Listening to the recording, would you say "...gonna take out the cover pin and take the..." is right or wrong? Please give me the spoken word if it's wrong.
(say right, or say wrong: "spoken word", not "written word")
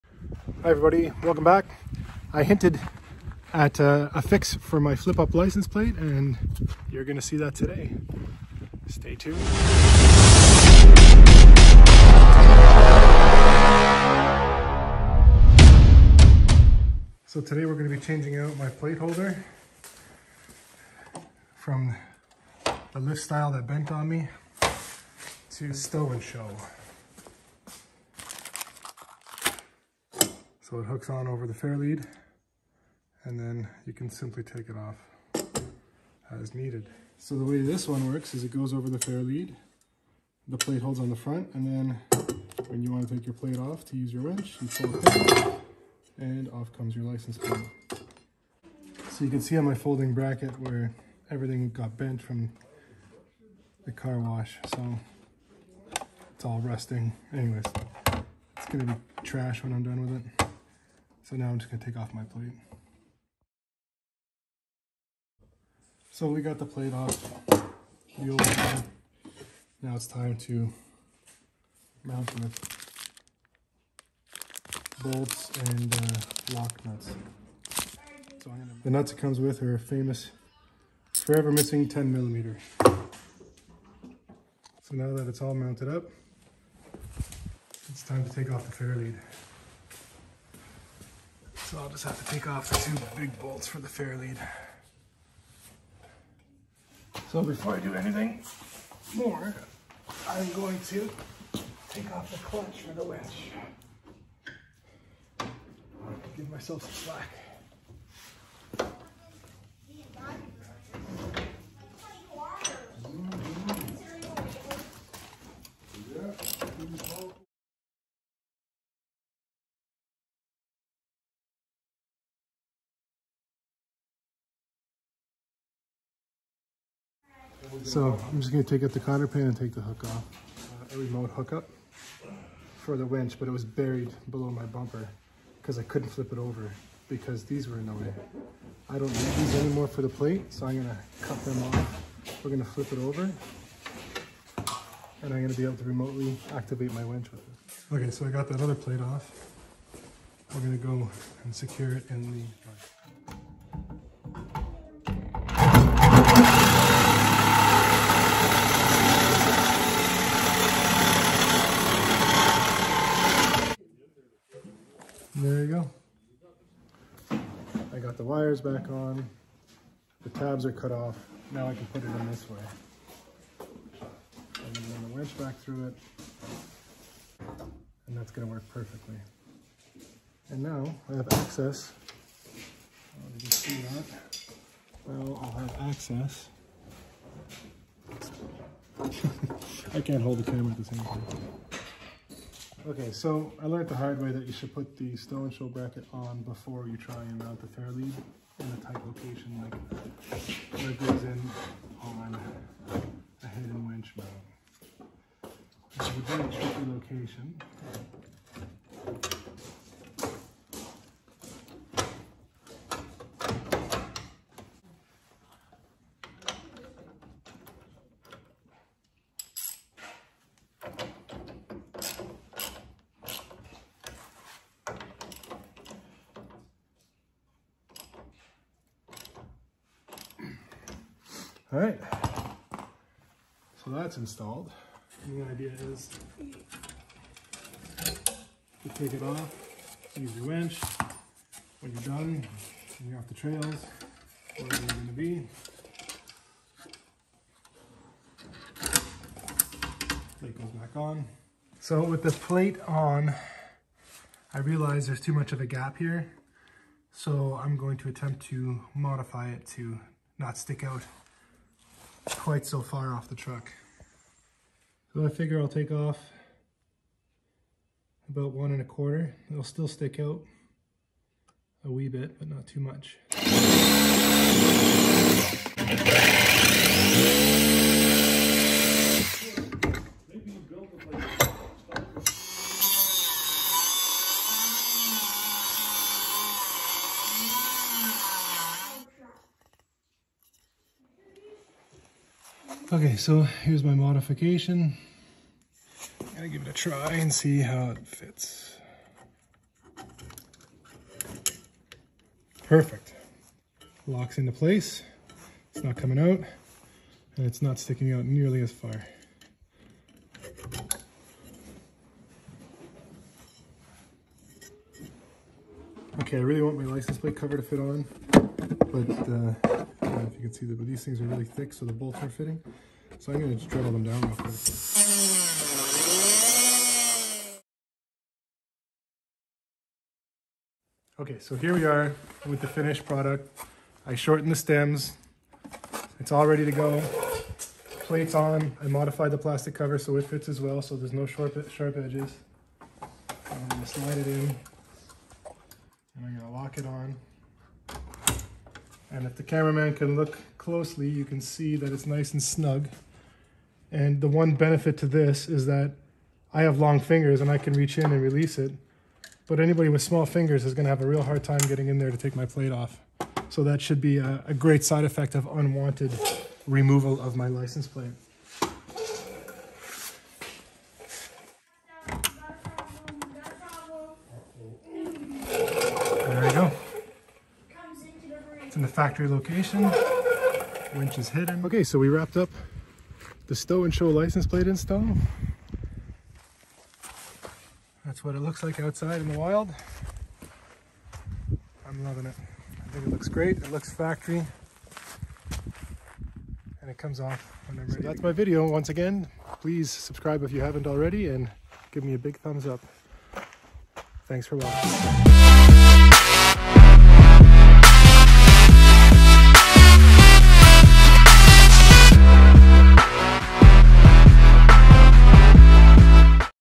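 wrong: "cotter", not "cover".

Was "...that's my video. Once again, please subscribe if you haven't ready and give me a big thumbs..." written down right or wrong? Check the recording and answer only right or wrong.
wrong.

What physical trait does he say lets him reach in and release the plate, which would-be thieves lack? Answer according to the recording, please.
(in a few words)
Long fingers.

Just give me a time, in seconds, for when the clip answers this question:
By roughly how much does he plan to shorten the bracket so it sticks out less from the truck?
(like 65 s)
268 s.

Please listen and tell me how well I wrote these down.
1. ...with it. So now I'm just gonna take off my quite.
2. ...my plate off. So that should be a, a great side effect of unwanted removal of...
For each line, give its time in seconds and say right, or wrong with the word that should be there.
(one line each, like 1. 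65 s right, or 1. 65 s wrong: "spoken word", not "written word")
1. 60 s wrong: "plate", not "quite"
2. 362 s right.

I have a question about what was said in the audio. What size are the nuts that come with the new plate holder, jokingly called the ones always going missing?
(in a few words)
10 millimeter.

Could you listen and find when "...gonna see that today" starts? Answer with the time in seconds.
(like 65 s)
7 s.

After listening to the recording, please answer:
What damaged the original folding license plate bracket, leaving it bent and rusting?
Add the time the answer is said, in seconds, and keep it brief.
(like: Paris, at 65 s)
The car wash, at 53 s.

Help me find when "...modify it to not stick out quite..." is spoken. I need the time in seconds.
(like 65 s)
258 s.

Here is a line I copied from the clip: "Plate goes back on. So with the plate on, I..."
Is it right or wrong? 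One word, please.
right.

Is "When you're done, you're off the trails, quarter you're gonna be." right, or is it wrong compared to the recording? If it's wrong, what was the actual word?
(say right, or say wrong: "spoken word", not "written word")
wrong: "wherever", not "quarter".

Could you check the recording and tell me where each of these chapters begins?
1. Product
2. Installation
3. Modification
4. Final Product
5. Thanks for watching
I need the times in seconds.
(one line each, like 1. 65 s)
1. 27 s
2. 103 s
3. 254 s
4. 331 s
5. 394 s.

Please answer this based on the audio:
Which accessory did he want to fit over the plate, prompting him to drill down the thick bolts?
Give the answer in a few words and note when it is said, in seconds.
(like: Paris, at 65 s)
License plate cover, at 316 s.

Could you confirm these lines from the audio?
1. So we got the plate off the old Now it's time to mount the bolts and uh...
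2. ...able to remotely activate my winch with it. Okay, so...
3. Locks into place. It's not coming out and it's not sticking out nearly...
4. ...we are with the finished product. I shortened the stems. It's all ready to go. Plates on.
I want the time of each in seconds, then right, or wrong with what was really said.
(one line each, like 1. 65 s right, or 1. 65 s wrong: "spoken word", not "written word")
1. 66 s right
2. 145 s right
3. 304 s right
4. 331 s right.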